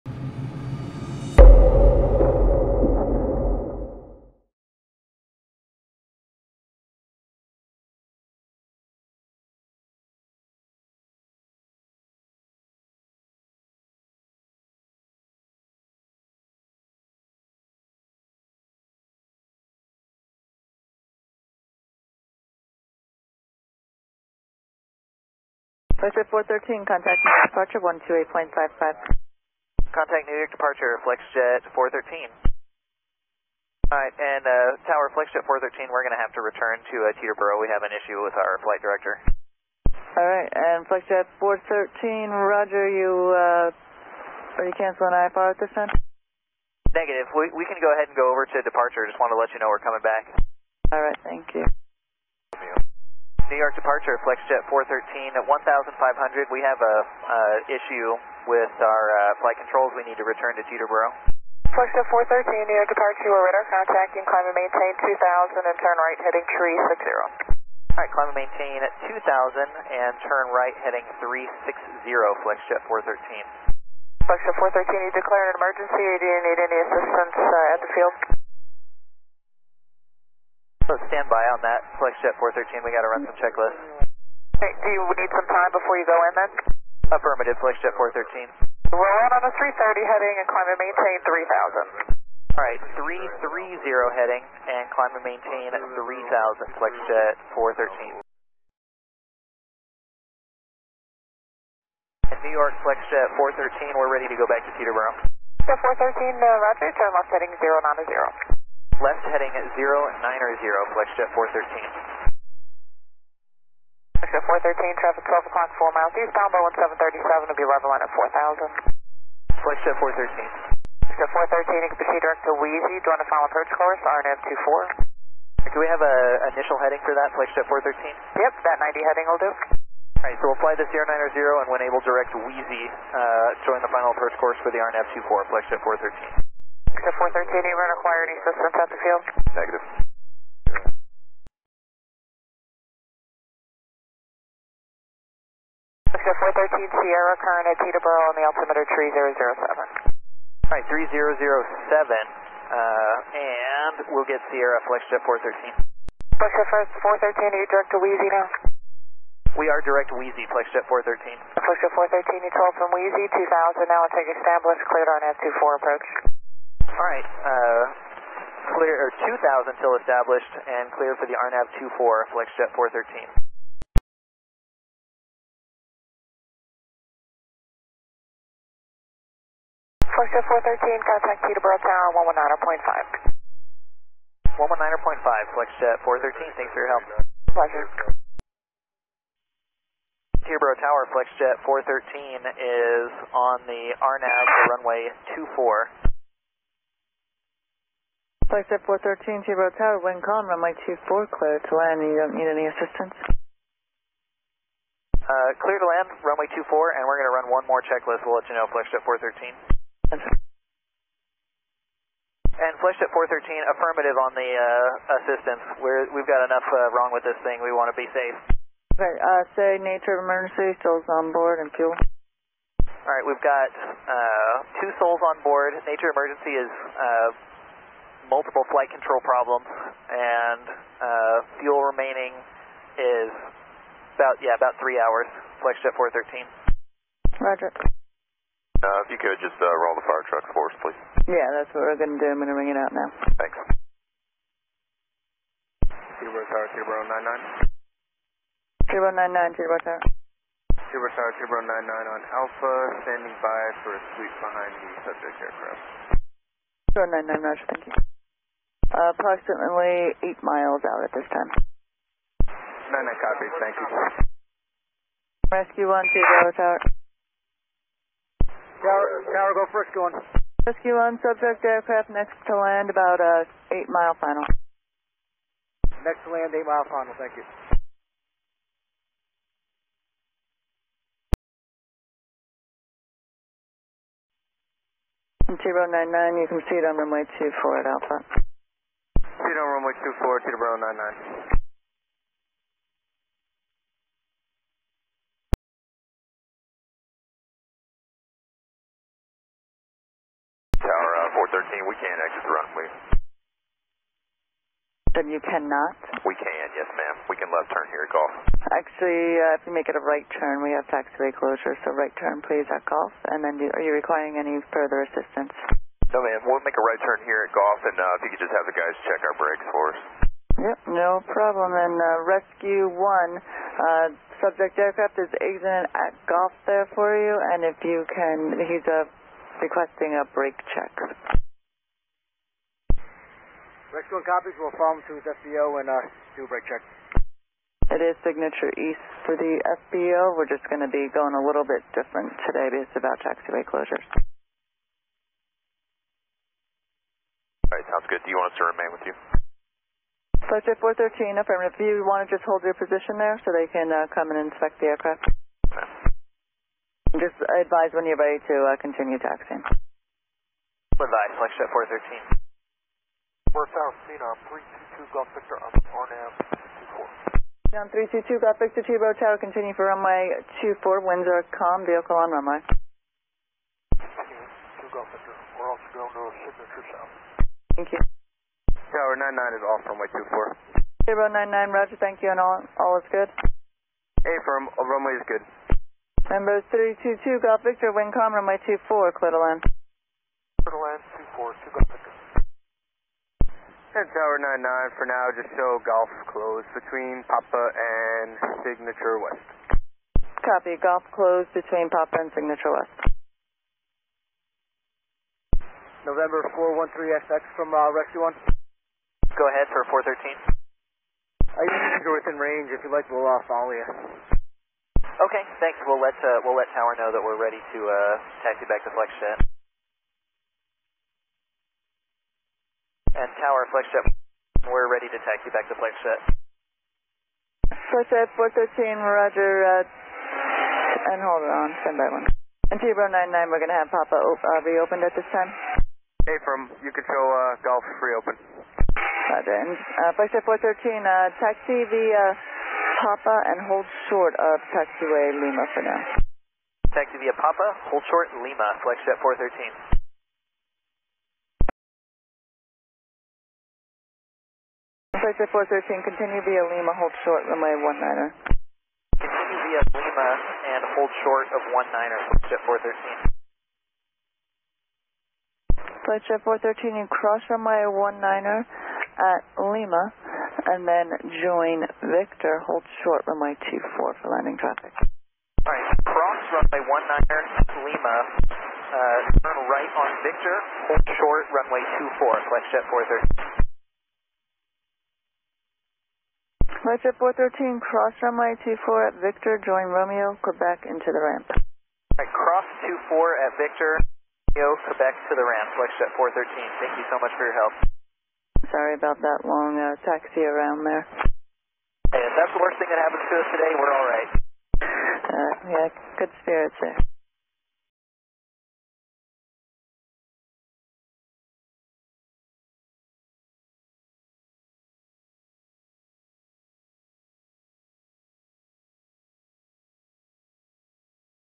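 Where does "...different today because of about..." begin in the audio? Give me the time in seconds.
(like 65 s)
341 s.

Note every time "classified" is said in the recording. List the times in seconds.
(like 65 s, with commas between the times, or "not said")
not said.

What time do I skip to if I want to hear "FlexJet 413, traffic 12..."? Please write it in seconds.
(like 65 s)
114 s.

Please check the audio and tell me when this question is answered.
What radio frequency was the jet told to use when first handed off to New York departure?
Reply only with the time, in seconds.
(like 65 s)
27 s.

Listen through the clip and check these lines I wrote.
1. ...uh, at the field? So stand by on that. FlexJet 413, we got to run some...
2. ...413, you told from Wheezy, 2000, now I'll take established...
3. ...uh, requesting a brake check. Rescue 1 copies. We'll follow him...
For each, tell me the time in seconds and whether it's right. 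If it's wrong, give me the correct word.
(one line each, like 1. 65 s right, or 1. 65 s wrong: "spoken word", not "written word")
1. 77 s right
2. 161 s right
3. 328 s right.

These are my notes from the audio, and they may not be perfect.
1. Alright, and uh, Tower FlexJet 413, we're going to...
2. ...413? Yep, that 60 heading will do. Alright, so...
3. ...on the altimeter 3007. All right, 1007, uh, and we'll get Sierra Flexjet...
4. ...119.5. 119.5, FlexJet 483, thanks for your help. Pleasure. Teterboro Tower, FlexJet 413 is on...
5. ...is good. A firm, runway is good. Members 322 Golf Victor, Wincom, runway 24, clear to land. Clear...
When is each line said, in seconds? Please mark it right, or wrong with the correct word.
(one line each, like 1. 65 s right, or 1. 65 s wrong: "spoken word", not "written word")
1. 33 s right
2. 127 s wrong: "90", not "60"
3. 148 s wrong: "3007", not "1007"
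4. 182 s wrong: "413", not "483"
5. 382 s right.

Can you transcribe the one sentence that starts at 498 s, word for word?
Sorry about that long uh, taxi around there.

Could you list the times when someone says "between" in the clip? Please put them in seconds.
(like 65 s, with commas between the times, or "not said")
396 s, 401 s.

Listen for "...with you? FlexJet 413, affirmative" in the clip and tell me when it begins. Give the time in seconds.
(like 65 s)
348 s.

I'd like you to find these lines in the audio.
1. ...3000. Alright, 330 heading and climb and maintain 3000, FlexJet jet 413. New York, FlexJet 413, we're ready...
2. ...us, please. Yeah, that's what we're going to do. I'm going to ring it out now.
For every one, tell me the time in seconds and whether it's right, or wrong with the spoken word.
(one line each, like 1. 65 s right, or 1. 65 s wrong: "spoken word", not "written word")
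1. 92 s right
2. 240 s right.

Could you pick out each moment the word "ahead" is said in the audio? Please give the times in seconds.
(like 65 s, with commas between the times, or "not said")
47 s, 409 s.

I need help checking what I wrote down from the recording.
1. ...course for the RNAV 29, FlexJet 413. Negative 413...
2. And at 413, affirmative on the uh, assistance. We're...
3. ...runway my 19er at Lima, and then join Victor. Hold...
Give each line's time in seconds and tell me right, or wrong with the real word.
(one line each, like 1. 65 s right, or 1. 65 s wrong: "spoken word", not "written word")
1. 134 s wrong: "24", not "29"
2. 210 s right
3. 467 s right.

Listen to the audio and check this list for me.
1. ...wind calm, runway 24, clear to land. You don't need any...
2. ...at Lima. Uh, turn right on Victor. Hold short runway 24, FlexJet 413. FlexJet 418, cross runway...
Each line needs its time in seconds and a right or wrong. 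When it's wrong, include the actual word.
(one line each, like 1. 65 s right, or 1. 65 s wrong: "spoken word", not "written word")
1. 200 s right
2. 477 s wrong: "413", not "418".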